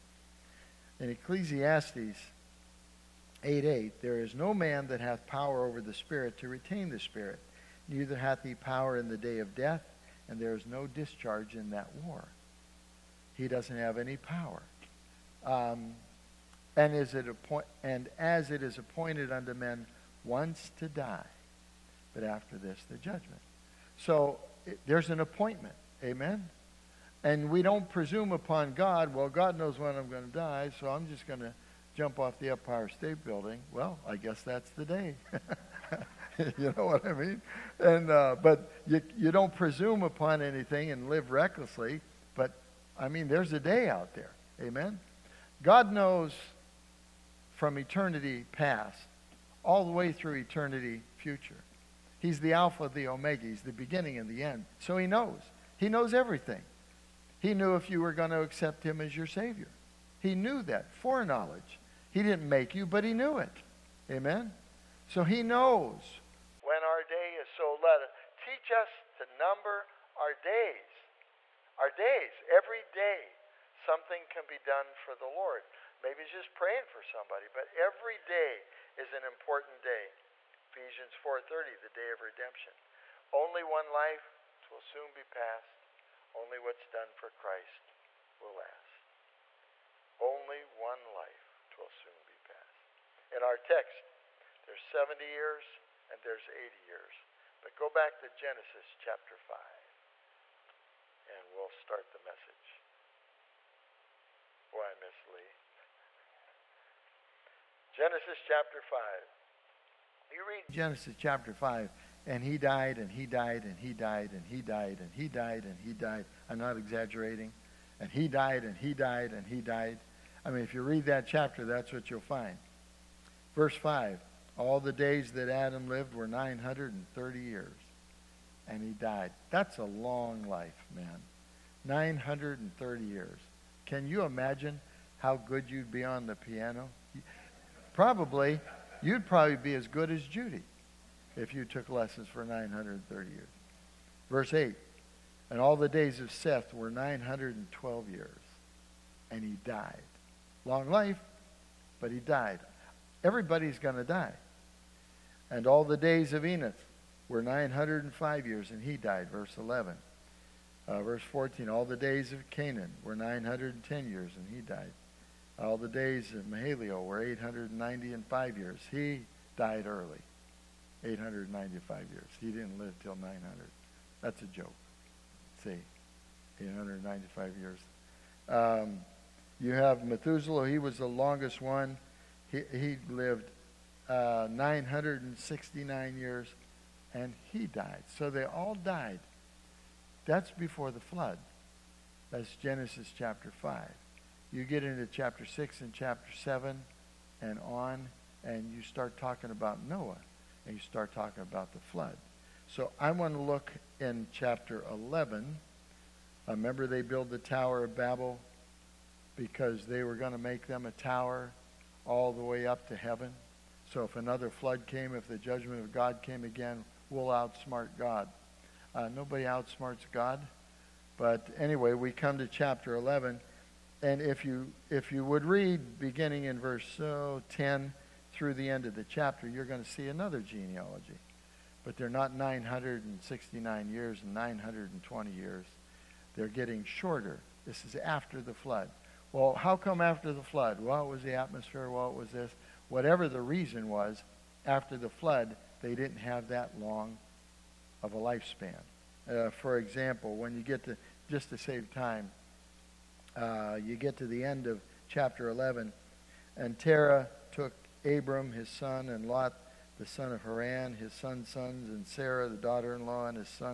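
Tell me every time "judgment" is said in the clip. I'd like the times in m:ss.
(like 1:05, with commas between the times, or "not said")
0:22, 3:35.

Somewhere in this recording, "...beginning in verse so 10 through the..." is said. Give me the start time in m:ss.
3:45.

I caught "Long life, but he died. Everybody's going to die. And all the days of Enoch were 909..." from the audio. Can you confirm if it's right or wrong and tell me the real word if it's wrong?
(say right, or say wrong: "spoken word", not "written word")
wrong: "905", not "909".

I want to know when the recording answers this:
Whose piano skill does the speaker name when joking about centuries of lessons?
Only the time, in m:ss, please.
2:20.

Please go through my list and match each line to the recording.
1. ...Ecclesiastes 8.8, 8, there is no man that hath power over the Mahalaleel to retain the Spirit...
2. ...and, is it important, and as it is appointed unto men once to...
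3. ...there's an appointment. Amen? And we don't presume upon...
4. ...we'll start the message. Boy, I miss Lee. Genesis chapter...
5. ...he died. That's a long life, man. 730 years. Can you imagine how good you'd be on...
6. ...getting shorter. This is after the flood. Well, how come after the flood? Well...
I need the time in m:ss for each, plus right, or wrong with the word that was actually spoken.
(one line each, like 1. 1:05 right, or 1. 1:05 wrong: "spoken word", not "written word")
1. 0:01 wrong: "Spirit", not "Mahalaleel"
2. 0:16 wrong: "appoint", not "important"
3. 0:24 right
4. 1:41 right
5. 2:08 wrong: "930", not "730"
6. 3:56 right.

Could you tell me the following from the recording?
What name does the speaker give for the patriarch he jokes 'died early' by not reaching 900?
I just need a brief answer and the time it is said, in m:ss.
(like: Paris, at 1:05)
Mahalaleel, at 2:46.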